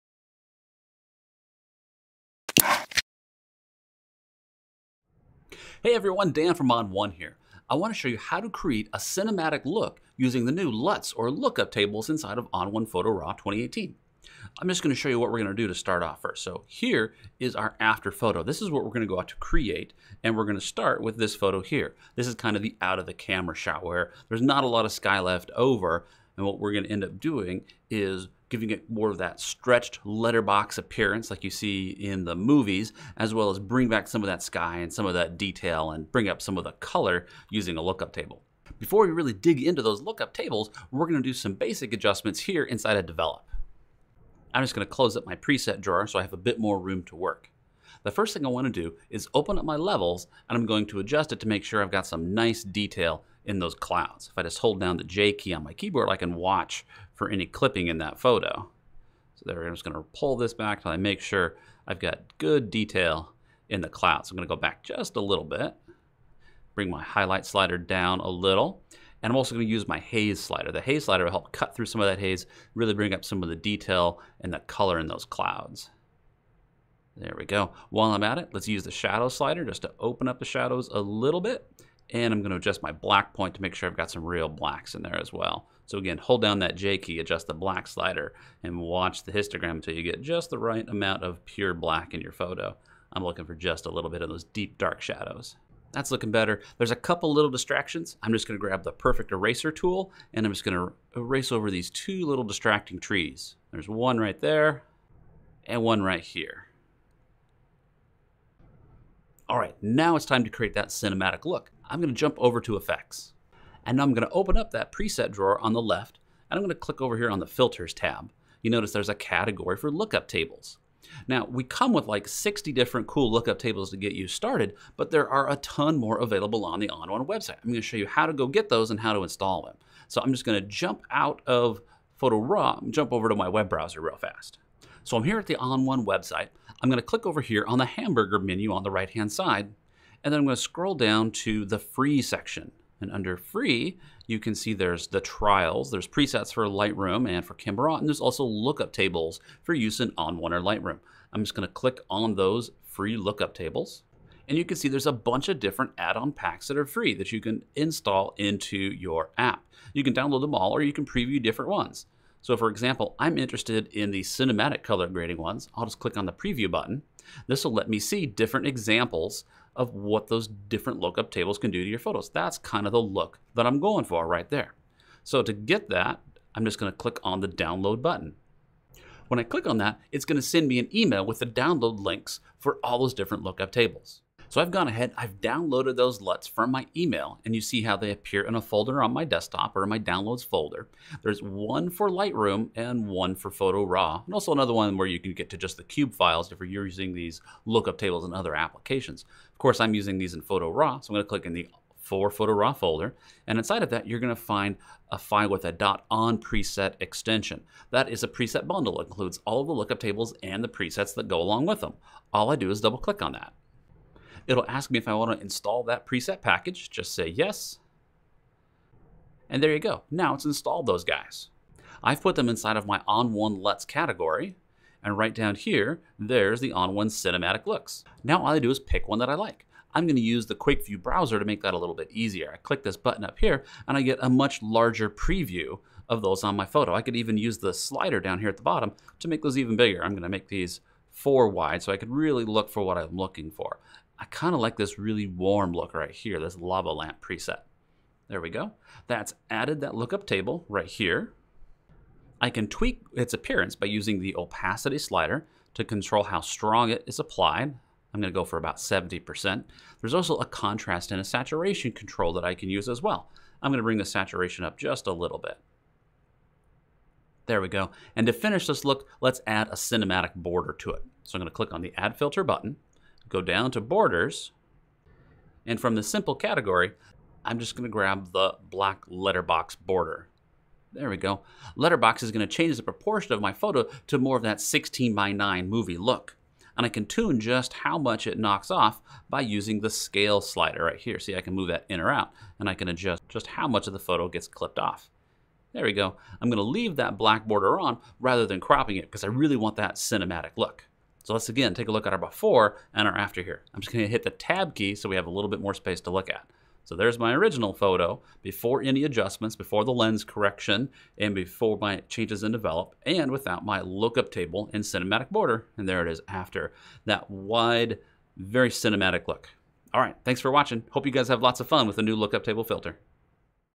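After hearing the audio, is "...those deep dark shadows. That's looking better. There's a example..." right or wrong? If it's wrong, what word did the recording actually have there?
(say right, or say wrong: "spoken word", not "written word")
wrong: "couple", not "example".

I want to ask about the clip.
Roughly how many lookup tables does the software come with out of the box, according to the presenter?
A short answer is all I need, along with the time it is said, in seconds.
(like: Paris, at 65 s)
60, at 122 s.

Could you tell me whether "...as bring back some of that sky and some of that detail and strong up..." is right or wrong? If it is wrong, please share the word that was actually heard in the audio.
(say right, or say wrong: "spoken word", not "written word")
wrong: "bring", not "strong".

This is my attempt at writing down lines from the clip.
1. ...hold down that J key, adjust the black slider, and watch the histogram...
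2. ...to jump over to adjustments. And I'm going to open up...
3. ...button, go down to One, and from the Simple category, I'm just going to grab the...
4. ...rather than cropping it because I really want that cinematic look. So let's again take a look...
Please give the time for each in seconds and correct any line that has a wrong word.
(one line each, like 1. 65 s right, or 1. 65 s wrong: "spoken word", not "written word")
1. 86 s right
2. 112 s wrong: "effects", not "adjustments"
3. 272 s wrong: "Borders", not "One"
4. 298 s right.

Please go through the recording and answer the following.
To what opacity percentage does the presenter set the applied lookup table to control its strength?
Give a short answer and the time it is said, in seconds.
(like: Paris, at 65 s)
70%, at 258 s.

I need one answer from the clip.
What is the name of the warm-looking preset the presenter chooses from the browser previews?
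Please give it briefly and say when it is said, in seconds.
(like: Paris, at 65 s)
Lava lamp, at 246 s.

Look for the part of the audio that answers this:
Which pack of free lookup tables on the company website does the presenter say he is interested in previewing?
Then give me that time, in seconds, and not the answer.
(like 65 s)
164 s.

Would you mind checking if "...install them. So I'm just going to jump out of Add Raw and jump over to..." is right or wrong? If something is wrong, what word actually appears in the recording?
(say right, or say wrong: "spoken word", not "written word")
wrong: "Photo", not "Add".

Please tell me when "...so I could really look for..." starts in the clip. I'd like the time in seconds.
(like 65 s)
241 s.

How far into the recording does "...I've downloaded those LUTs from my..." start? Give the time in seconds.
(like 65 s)
185 s.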